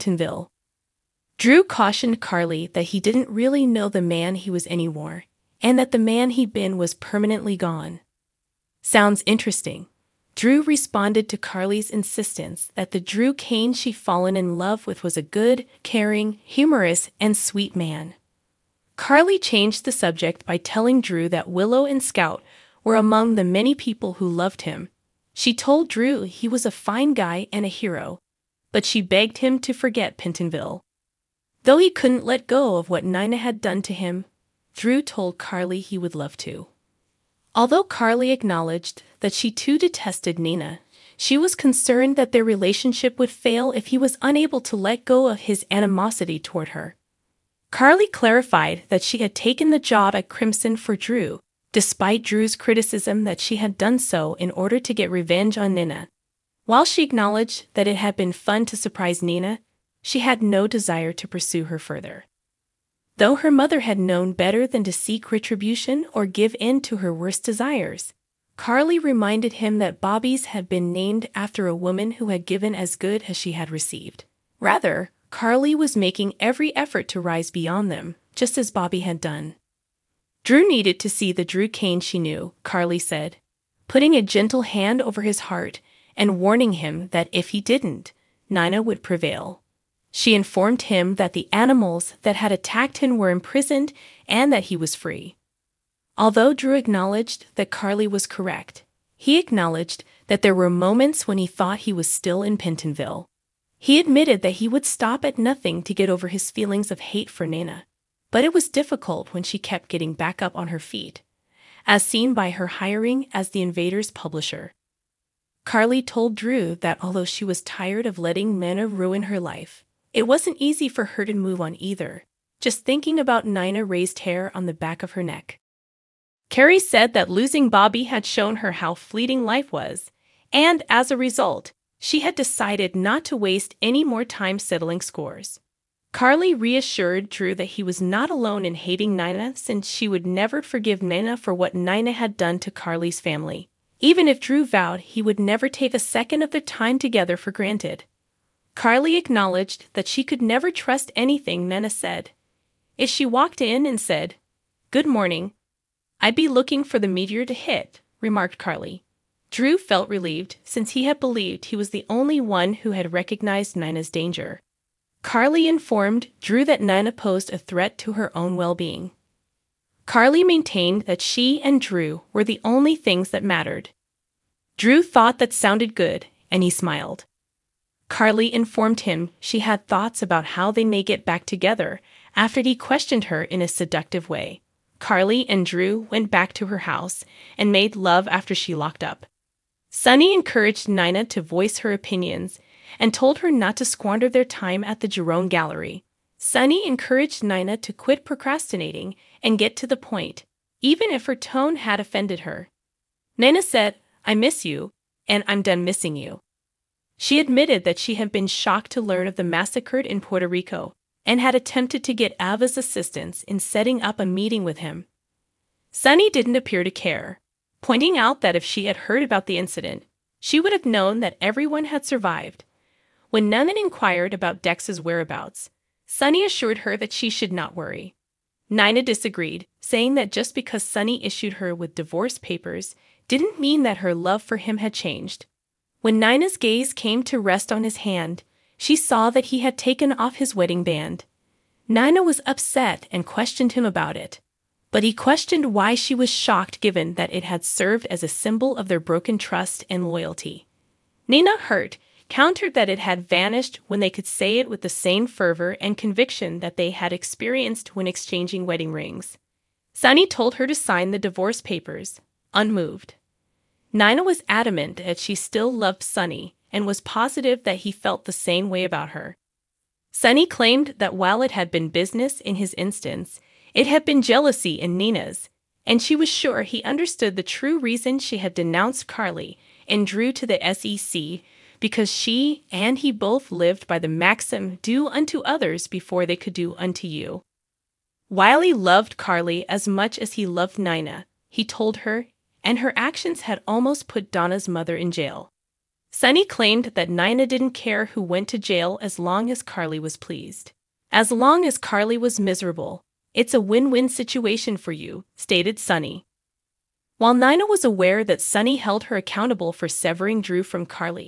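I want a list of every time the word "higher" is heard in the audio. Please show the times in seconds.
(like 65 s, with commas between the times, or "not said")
not said.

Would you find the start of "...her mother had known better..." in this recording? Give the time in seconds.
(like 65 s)
63 s.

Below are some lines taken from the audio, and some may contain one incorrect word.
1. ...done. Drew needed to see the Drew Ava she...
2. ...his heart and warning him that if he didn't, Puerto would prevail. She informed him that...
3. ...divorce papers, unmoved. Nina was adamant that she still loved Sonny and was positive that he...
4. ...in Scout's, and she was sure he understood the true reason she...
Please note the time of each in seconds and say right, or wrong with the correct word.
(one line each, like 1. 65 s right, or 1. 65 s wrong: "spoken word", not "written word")
1. 79 s wrong: "Kane", not "Ava"
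2. 85 s wrong: "Nina", not "Puerto"
3. 261 s right
4. 274 s wrong: "Nina", not "Scout".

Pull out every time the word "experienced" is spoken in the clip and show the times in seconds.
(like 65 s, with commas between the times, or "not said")
257 s.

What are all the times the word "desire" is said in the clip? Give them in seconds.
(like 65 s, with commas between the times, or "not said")
60 s, 67 s.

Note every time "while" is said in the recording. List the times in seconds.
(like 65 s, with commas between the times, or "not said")
56 s, 271 s, 307 s.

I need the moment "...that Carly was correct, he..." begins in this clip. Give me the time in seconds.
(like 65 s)
97 s.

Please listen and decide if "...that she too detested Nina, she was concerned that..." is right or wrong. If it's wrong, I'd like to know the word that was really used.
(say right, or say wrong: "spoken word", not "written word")
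right.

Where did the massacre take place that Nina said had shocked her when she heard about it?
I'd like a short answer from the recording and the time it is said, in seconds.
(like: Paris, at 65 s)
Puerto Rico, at 210 s.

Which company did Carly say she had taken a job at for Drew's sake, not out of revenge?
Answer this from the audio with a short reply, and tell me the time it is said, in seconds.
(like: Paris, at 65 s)
Crimson, at 50 s.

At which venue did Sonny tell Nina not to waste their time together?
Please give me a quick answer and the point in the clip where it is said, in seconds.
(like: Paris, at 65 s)
Jerome Gallery, at 195 s.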